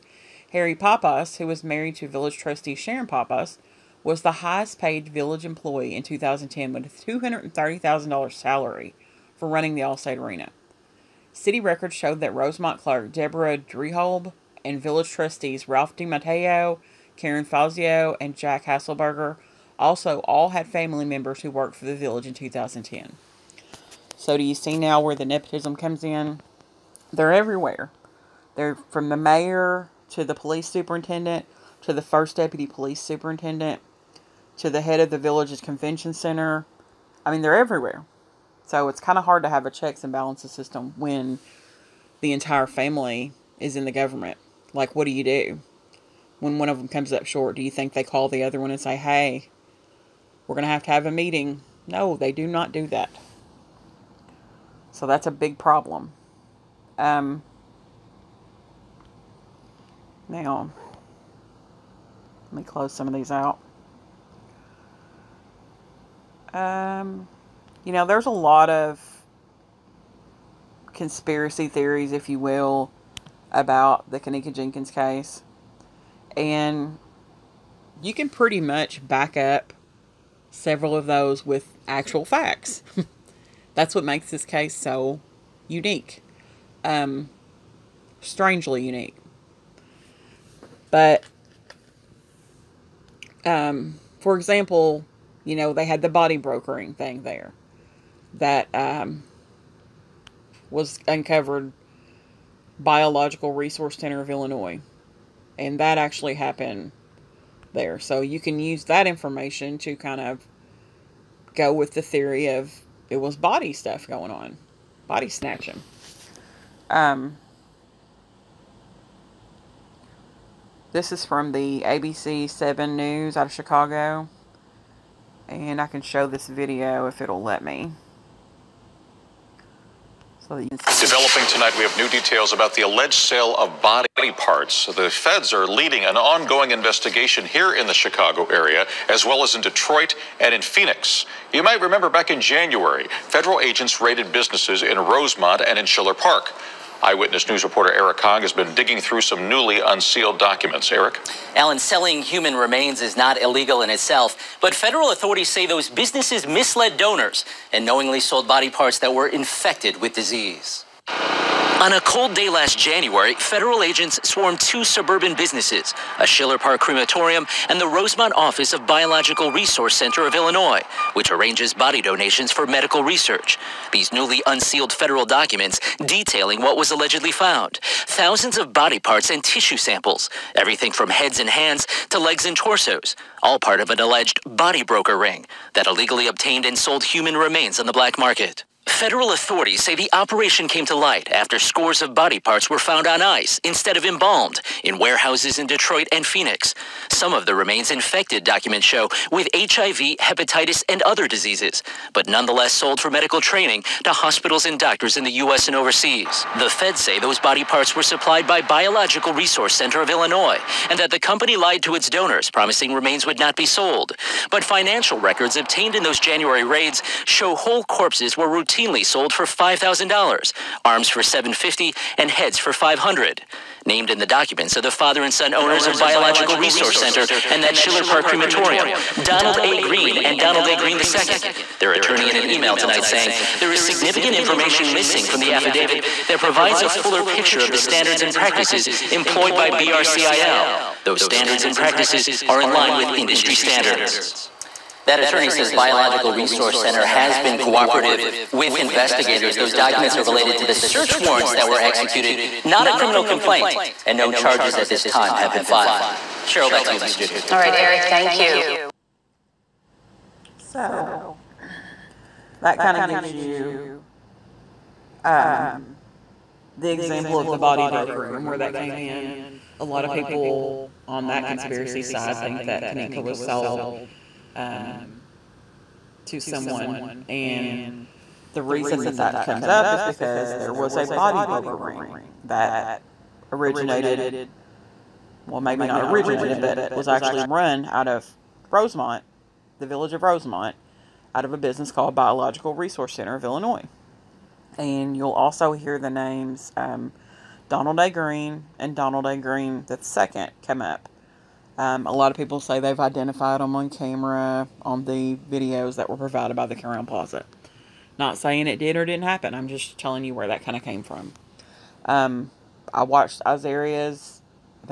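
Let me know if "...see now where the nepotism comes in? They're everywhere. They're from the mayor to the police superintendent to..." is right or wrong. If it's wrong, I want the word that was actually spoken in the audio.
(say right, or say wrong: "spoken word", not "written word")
right.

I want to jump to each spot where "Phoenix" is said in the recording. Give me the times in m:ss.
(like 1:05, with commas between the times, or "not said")
2:20, 3:16.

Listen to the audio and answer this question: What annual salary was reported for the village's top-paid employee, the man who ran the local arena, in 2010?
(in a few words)
$230,000.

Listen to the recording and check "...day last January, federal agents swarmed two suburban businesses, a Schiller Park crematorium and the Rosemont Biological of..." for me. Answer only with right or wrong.
wrong.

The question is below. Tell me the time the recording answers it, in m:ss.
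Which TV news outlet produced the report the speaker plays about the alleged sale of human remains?
2:01.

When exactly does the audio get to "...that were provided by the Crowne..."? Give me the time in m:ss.
5:05.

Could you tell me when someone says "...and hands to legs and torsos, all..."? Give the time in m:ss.
3:01.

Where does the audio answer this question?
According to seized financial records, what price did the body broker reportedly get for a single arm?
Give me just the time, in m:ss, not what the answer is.
3:41.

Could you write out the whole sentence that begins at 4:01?
Those standards and practices are in line with industry standards.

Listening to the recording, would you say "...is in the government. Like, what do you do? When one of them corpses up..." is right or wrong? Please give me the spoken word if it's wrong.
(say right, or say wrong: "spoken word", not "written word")
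wrong: "comes", not "corpses".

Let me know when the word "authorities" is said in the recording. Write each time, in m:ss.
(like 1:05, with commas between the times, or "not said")
2:35, 3:09.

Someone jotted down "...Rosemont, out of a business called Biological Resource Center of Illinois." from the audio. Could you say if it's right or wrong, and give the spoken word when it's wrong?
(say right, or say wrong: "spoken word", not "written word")
right.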